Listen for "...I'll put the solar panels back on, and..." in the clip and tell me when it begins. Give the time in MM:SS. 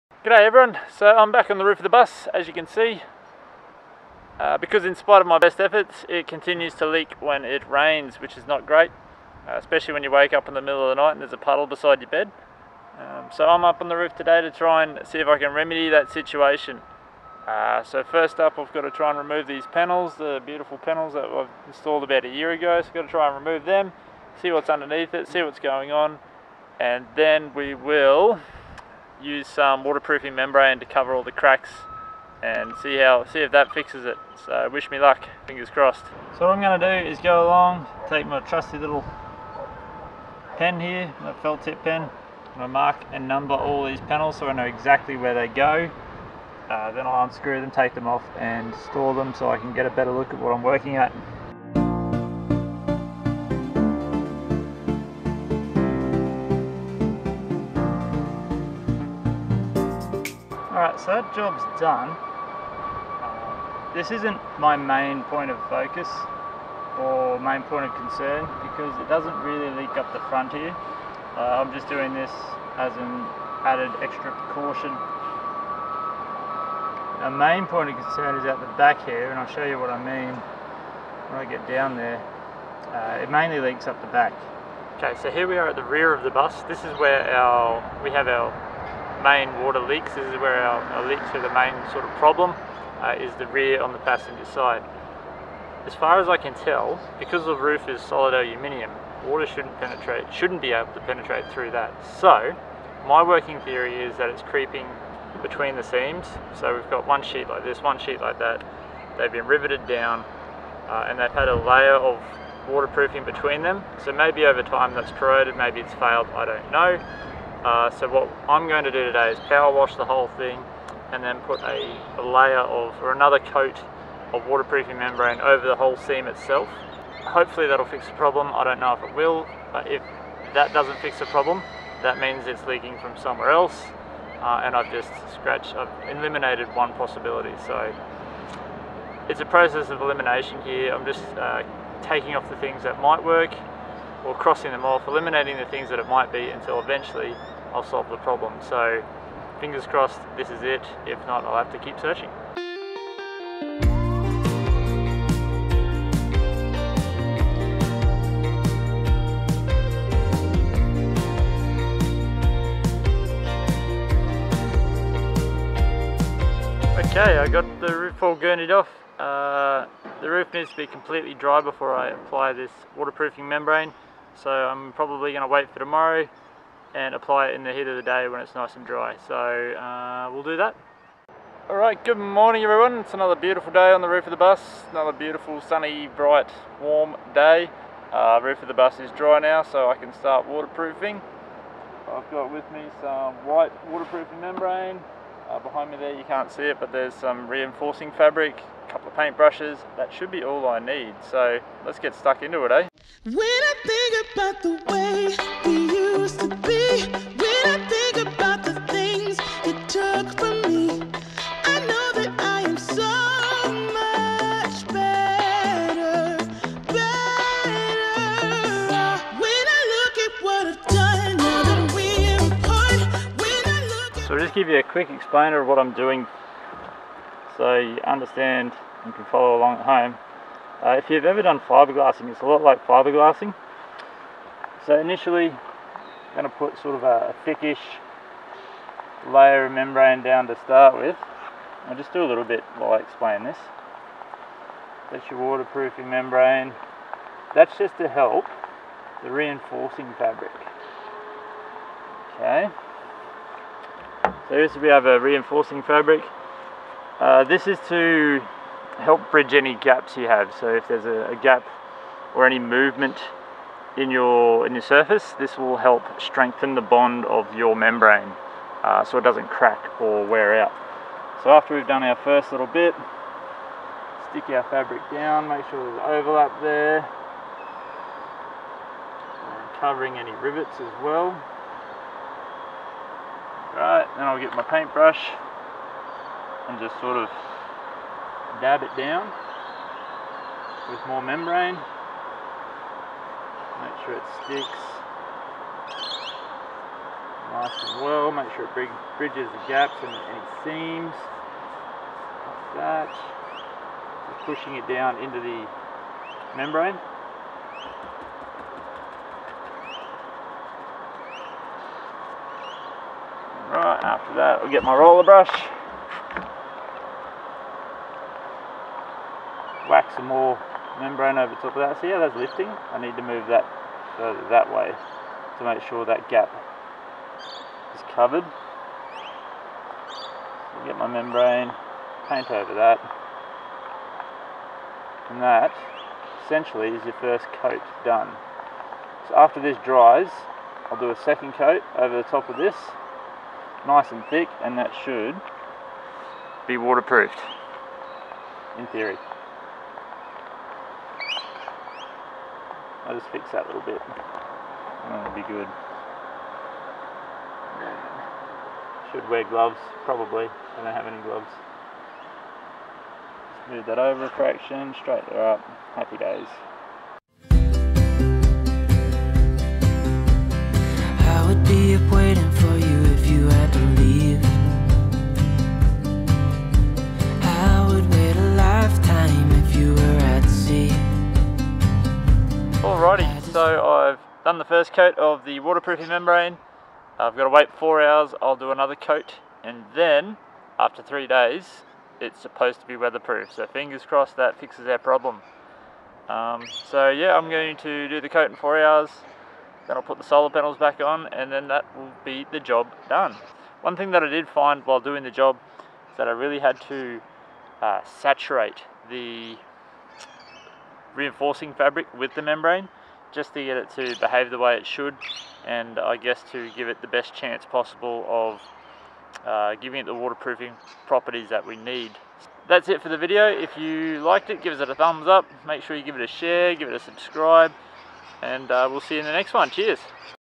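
06:39.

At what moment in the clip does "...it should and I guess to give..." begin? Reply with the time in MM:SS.
06:54.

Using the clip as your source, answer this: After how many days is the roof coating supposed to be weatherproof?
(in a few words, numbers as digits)
3.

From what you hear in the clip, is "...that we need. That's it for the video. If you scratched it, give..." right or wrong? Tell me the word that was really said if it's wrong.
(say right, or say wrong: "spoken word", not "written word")
wrong: "liked", not "scratched".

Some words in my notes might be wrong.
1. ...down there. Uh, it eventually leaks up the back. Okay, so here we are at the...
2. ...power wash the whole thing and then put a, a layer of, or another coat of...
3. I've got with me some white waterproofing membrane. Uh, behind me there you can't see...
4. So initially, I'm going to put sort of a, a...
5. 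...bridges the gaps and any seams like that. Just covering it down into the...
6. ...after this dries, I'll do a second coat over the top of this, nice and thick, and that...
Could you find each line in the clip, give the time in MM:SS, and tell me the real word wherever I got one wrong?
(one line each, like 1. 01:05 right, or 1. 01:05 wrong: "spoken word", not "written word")
1. 01:21 wrong: "mainly", not "eventually"
2. 01:59 right
3. 03:12 right
4. 03:54 right
5. 04:59 wrong: "pushing", not "covering"
6. 05:39 right.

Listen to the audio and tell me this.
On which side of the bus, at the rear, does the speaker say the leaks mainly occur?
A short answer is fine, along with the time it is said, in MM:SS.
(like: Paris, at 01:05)
Passenger side, at 01:33.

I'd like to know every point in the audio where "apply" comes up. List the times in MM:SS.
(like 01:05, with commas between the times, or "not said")
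02:52, 02:57.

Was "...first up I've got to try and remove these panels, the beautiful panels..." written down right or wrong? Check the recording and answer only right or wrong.
right.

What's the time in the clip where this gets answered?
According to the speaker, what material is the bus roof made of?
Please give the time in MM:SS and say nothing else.
01:38.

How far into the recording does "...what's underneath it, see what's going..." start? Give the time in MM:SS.
00:24.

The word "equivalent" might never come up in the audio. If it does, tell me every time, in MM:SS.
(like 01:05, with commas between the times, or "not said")
not said.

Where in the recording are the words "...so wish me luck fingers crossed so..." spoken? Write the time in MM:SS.
00:34.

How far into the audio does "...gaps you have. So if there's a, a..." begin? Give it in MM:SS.
04:19.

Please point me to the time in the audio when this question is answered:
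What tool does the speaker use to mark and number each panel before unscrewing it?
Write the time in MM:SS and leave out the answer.
00:41.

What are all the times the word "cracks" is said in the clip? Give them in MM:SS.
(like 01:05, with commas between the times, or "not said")
00:31, 04:29.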